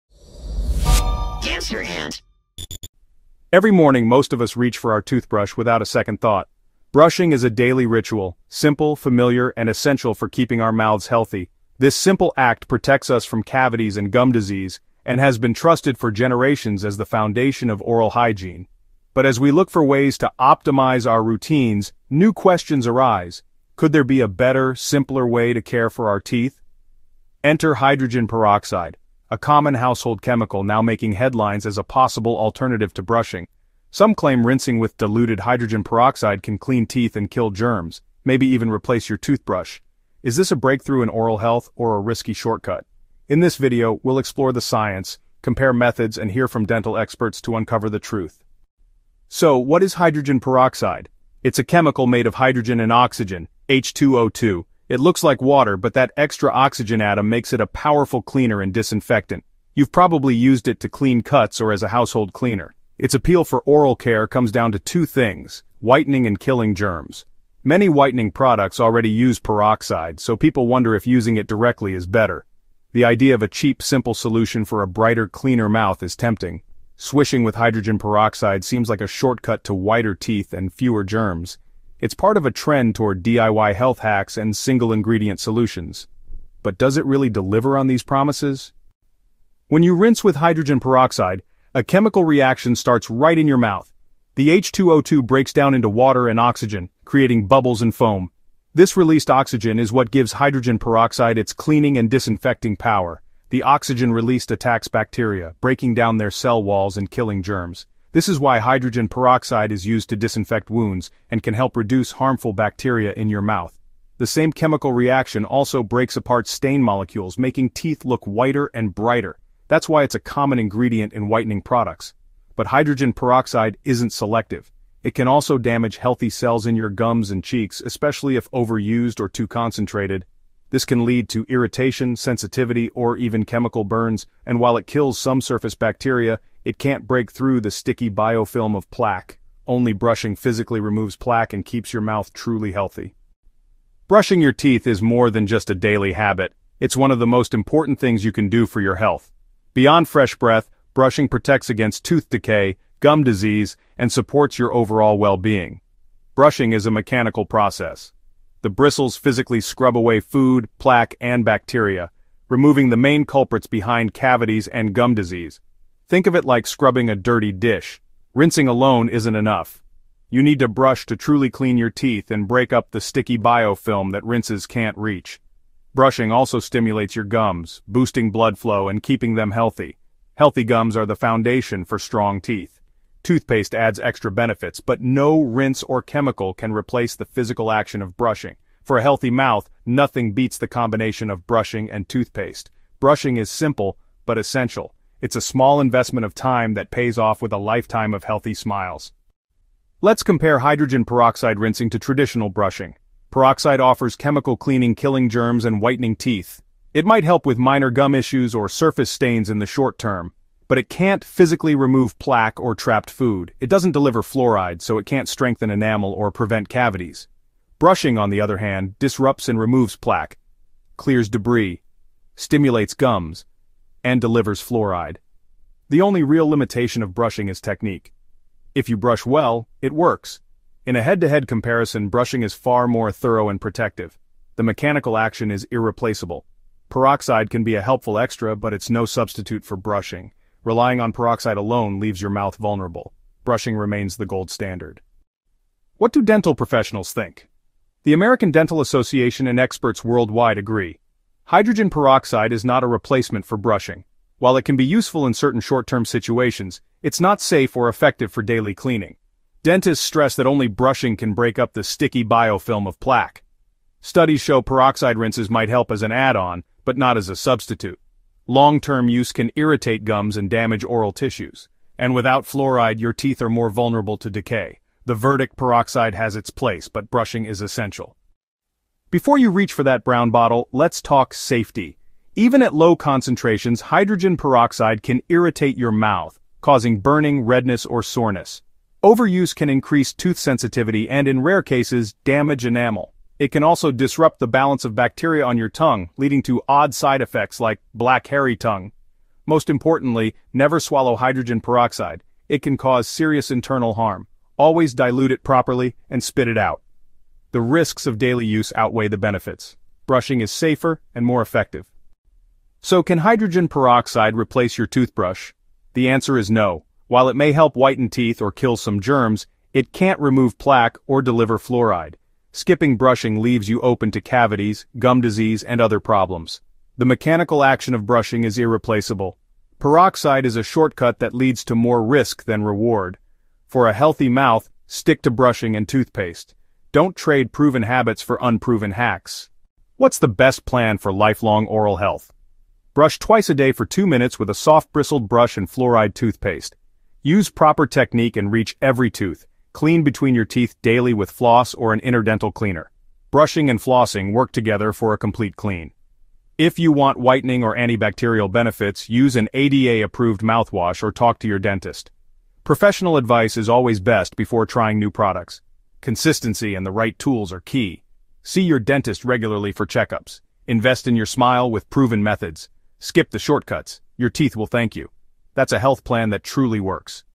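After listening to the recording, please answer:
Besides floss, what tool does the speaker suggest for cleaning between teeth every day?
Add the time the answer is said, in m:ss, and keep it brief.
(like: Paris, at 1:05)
interdental cleaner, at 5:52.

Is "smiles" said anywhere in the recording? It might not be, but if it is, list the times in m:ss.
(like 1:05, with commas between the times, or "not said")
3:18, 6:11.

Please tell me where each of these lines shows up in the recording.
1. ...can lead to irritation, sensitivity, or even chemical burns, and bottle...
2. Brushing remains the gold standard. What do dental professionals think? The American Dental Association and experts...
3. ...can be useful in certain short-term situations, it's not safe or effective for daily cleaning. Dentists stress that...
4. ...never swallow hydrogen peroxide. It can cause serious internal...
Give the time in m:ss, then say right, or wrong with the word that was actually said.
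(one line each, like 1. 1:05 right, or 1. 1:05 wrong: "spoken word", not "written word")
1. 2:10 wrong: "while", not "bottle"
2. 4:03 right
3. 4:14 right
4. 5:00 right.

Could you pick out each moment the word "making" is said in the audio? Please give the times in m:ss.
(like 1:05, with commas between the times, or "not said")
0:30, 1:57.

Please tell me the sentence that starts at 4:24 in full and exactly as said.
Studies show peroxide rinses might help as an add-on, but not as a substitute.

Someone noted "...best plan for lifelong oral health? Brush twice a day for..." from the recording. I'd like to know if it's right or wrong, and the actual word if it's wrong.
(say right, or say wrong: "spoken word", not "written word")
right.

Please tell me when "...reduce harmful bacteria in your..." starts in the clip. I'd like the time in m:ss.
1:51.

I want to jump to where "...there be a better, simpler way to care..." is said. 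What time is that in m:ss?
0:23.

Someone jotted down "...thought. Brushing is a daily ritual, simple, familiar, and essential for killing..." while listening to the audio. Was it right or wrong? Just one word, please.
wrong.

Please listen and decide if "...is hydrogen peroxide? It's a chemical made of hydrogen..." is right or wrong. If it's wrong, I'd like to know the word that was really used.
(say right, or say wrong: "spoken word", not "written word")
right.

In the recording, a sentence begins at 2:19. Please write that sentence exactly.
Only brushing physically removes plaque and keeps your mouth truly healthy.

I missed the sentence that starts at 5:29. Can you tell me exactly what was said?
Peroxide is a shortcut that leads to more risk than reward.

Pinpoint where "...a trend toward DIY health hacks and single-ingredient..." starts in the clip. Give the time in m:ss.
1:22.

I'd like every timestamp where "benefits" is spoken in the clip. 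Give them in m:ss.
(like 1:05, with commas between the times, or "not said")
3:04, 5:09, 5:58.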